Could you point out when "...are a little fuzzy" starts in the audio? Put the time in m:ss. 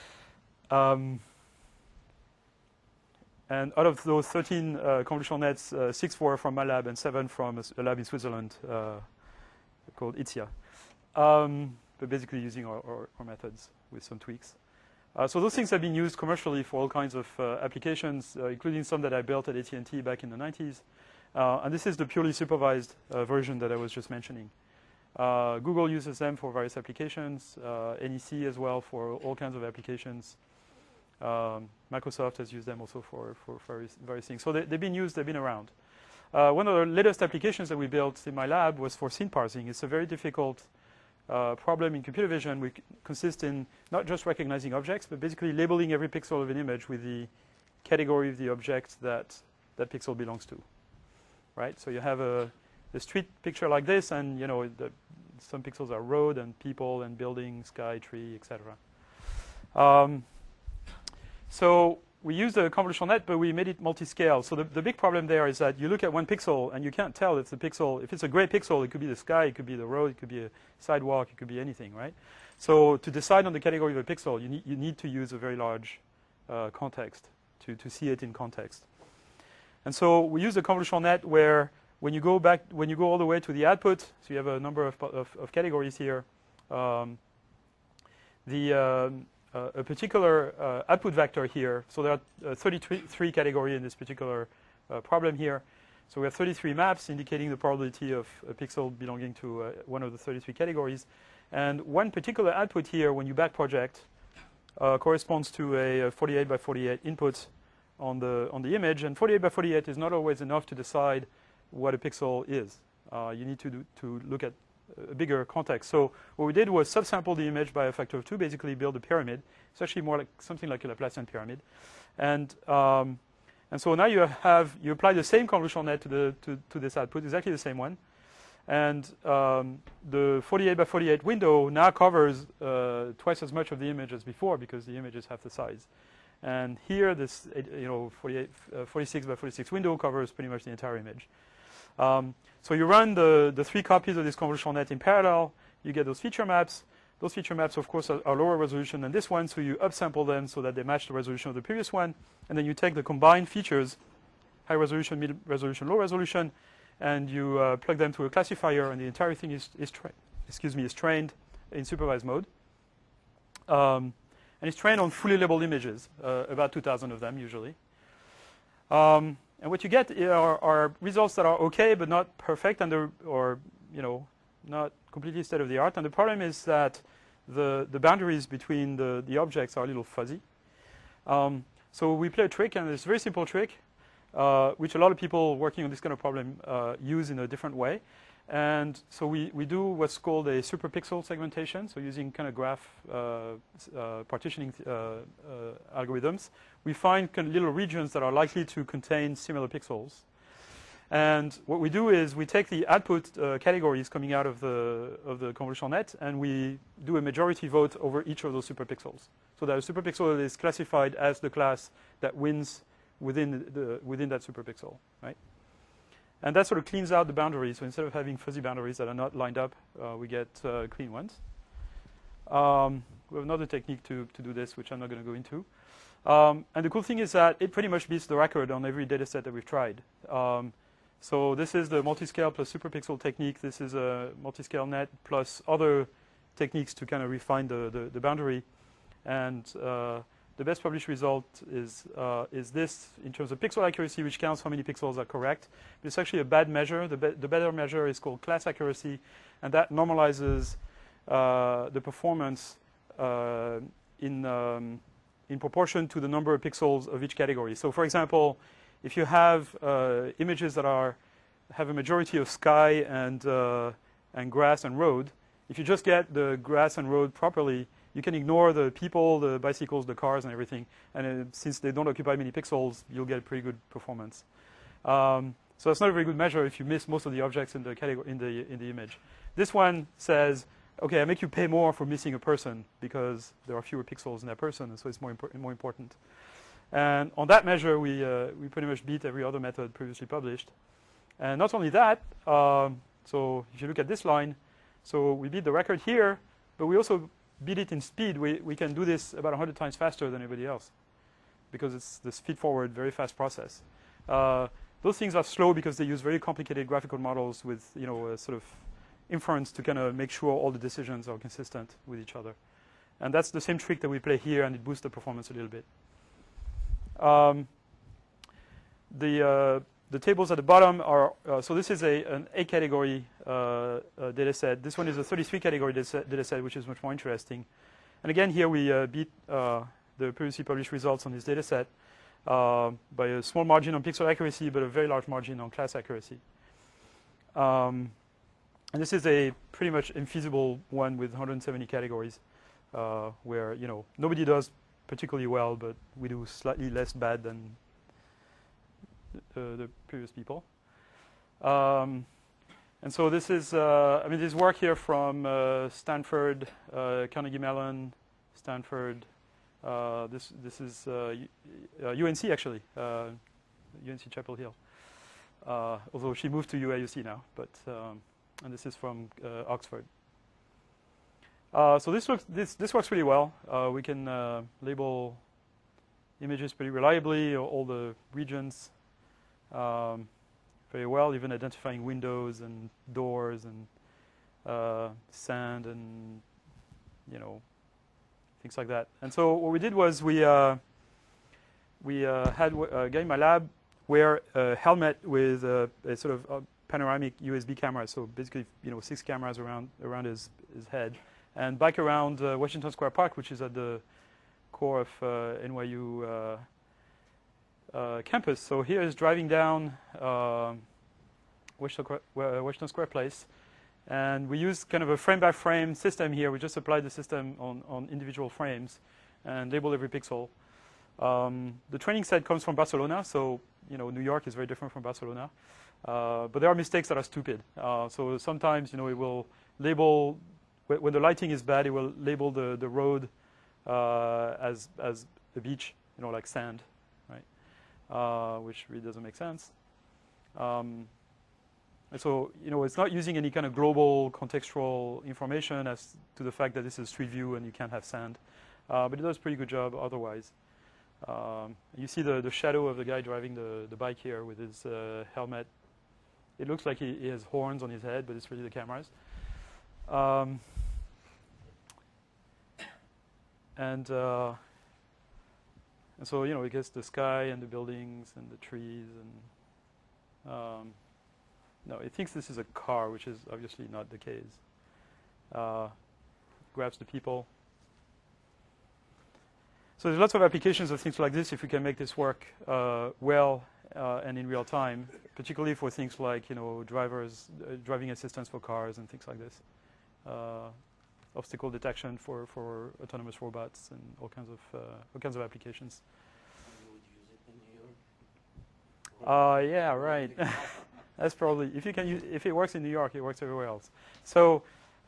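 2:59.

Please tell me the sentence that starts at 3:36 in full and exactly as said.
And that sort of cleans out the boundaries.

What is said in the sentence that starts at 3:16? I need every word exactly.
We find kind of little regions that are likely to contain similar pixels.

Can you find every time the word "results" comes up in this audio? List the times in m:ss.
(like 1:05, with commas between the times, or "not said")
2:51, 4:01, 5:30.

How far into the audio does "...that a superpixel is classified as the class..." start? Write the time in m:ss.
3:29.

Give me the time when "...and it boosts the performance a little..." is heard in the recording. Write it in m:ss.
5:14.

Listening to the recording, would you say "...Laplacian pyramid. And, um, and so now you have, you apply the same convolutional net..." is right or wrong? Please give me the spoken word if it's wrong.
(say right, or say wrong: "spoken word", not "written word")
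right.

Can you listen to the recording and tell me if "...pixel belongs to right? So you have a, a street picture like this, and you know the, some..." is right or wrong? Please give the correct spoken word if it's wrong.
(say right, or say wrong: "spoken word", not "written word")
right.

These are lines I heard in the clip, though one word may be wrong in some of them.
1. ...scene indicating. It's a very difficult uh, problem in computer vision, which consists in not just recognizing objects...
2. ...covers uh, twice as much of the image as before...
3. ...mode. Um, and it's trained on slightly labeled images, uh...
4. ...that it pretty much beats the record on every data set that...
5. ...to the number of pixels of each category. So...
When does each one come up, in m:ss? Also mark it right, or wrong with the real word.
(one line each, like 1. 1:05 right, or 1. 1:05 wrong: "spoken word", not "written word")
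1. 0:39 wrong: "parsing", not "indicating"
2. 2:11 right
3. 2:42 wrong: "fully", not "slightly"
4. 3:47 right
5. 4:16 right.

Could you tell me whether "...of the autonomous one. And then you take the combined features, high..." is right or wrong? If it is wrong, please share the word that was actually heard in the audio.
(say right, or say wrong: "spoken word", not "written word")
wrong: "previous", not "autonomous".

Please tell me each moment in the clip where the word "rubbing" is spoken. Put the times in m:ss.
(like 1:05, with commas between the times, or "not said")
not said.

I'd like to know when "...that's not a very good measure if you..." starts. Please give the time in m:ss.
4:35.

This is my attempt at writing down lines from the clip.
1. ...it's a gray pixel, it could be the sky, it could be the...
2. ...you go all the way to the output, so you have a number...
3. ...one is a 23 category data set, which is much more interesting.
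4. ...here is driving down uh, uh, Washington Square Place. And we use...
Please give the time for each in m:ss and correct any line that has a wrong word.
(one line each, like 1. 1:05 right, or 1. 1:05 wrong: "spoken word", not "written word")
1. 1:08 right
2. 1:22 right
3. 5:24 wrong: "33", not "23"
4. 6:48 right.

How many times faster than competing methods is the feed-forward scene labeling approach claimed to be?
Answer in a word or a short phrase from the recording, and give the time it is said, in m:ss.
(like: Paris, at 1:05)
100, at 4:59.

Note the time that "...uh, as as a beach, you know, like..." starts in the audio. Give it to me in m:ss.
7:13.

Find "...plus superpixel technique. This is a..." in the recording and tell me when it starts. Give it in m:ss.
3:52.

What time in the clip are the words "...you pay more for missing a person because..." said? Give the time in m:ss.
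4:41.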